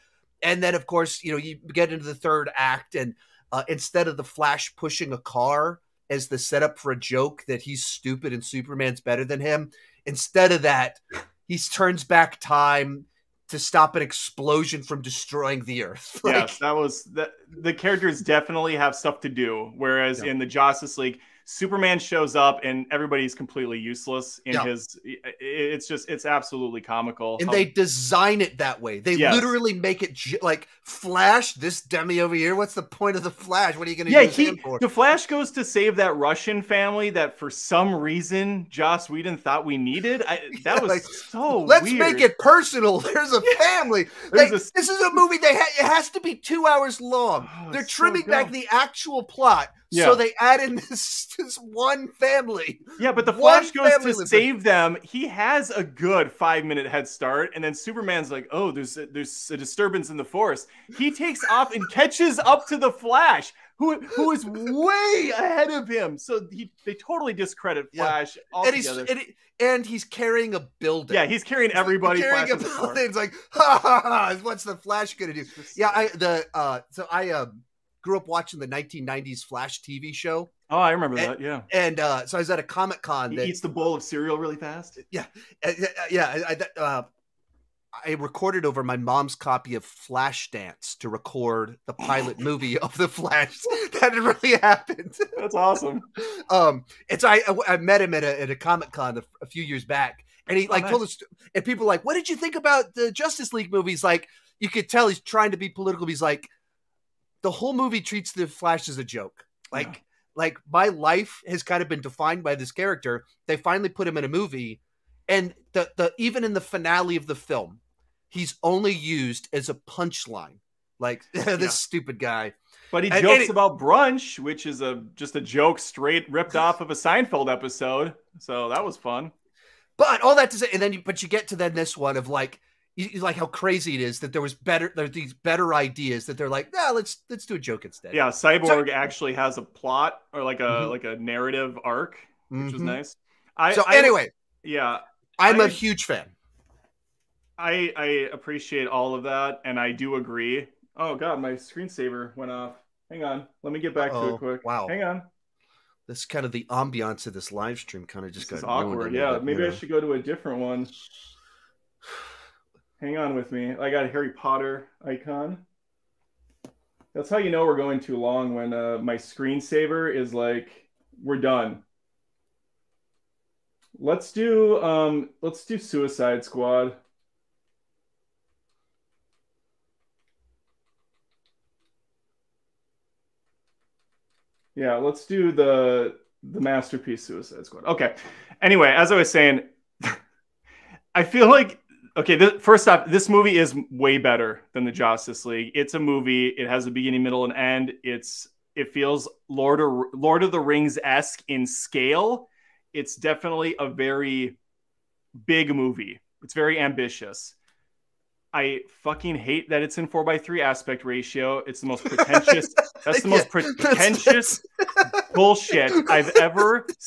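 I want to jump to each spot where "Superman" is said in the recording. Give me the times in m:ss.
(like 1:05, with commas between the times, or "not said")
0:08, 0:21, 0:57.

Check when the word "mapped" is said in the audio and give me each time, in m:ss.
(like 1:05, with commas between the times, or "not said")
not said.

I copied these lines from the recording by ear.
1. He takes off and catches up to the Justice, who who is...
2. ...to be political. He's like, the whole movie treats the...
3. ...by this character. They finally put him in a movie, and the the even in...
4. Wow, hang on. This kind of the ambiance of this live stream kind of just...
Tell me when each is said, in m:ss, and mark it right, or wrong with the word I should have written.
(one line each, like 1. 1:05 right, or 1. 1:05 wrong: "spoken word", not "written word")
1. 1:00 wrong: "Flash", not "Justice"
2. 1:45 right
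3. 1:52 right
4. 2:34 right.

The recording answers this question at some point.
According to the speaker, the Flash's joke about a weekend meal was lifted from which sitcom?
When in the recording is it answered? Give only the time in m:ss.
2:06.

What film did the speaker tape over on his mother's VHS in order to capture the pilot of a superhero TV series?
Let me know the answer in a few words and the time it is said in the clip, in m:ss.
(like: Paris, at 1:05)
Flashdance, at 1:29.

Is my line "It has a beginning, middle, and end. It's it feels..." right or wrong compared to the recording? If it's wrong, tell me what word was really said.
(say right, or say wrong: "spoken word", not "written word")
right.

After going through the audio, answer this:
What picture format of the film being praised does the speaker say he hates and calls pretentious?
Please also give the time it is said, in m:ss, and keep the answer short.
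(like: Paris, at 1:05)
4 by 3, at 3:30.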